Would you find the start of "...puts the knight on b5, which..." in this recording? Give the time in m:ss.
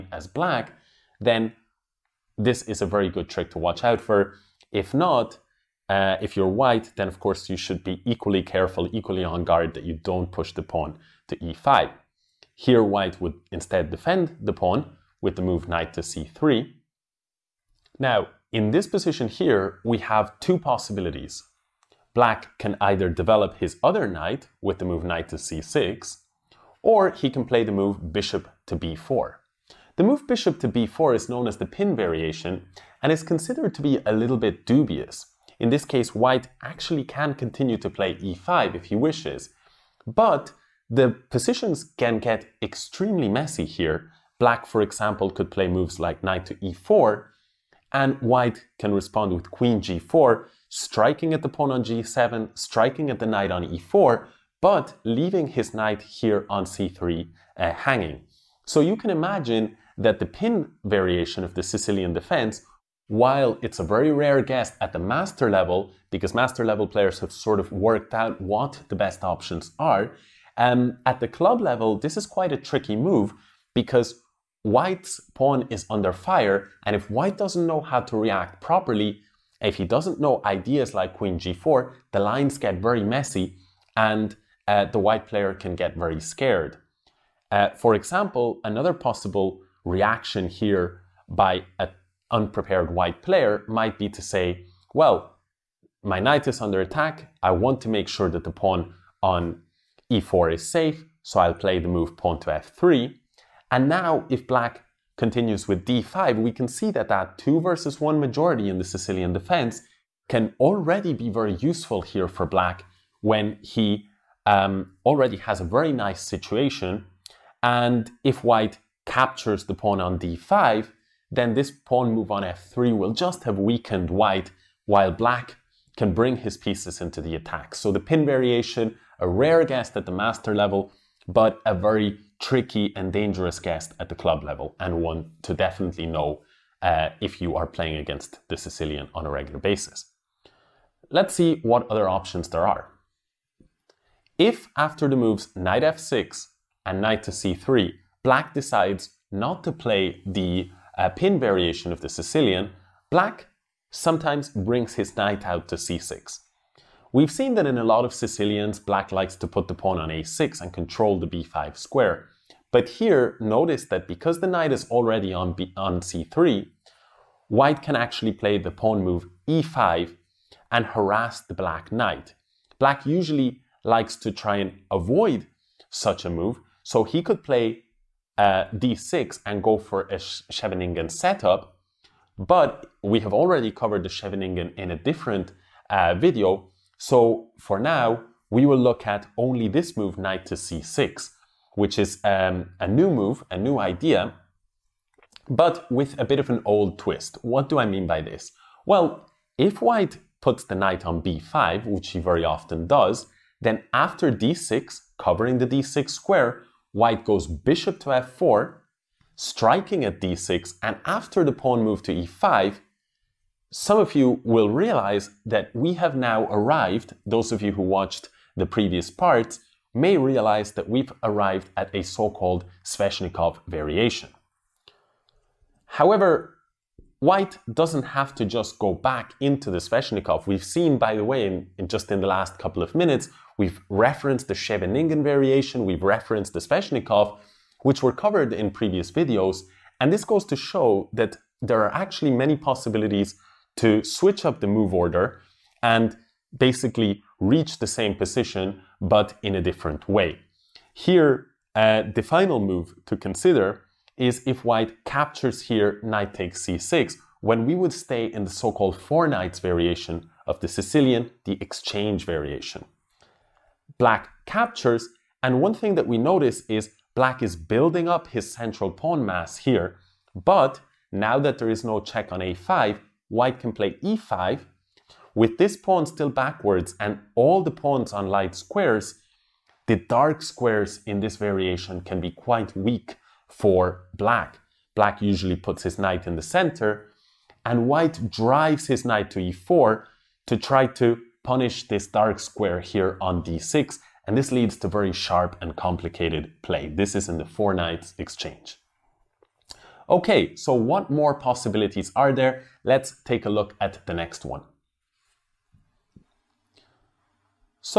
3:20.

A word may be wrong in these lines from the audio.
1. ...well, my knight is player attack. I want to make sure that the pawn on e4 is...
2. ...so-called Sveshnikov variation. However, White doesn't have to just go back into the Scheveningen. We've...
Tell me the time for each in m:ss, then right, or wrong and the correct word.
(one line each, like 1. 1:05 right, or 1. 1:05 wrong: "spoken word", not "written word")
1. 1:34 wrong: "under", not "player"
2. 3:42 wrong: "Sveshnikov", not "Scheveningen".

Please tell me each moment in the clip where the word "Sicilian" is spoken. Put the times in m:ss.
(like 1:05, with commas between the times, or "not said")
1:01, 1:48, 2:18, 2:32, 2:38, 4:20.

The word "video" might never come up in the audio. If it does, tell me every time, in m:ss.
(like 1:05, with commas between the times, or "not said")
3:06, 3:59.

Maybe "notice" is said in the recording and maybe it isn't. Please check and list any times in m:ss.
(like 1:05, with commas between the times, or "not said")
2:43, 4:26.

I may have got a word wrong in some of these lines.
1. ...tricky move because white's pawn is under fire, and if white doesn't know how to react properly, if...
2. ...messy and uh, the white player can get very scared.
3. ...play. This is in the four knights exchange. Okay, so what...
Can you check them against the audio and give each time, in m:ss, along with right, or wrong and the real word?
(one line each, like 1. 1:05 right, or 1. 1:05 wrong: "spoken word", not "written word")
1. 1:12 right
2. 1:23 right
3. 4:56 right.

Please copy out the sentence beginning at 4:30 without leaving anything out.
But now that there is no check on a5, white can play e5.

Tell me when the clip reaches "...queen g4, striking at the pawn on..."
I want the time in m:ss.
0:49.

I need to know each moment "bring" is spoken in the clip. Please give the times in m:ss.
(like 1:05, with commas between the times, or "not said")
2:06, 2:34.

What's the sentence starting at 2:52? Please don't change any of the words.
Black usually likes to try and avoid such a move, so he could play uh, d6 and go for a Scheveningen setup.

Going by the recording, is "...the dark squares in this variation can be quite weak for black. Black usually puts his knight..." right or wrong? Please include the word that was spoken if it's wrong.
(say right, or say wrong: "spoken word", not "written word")
right.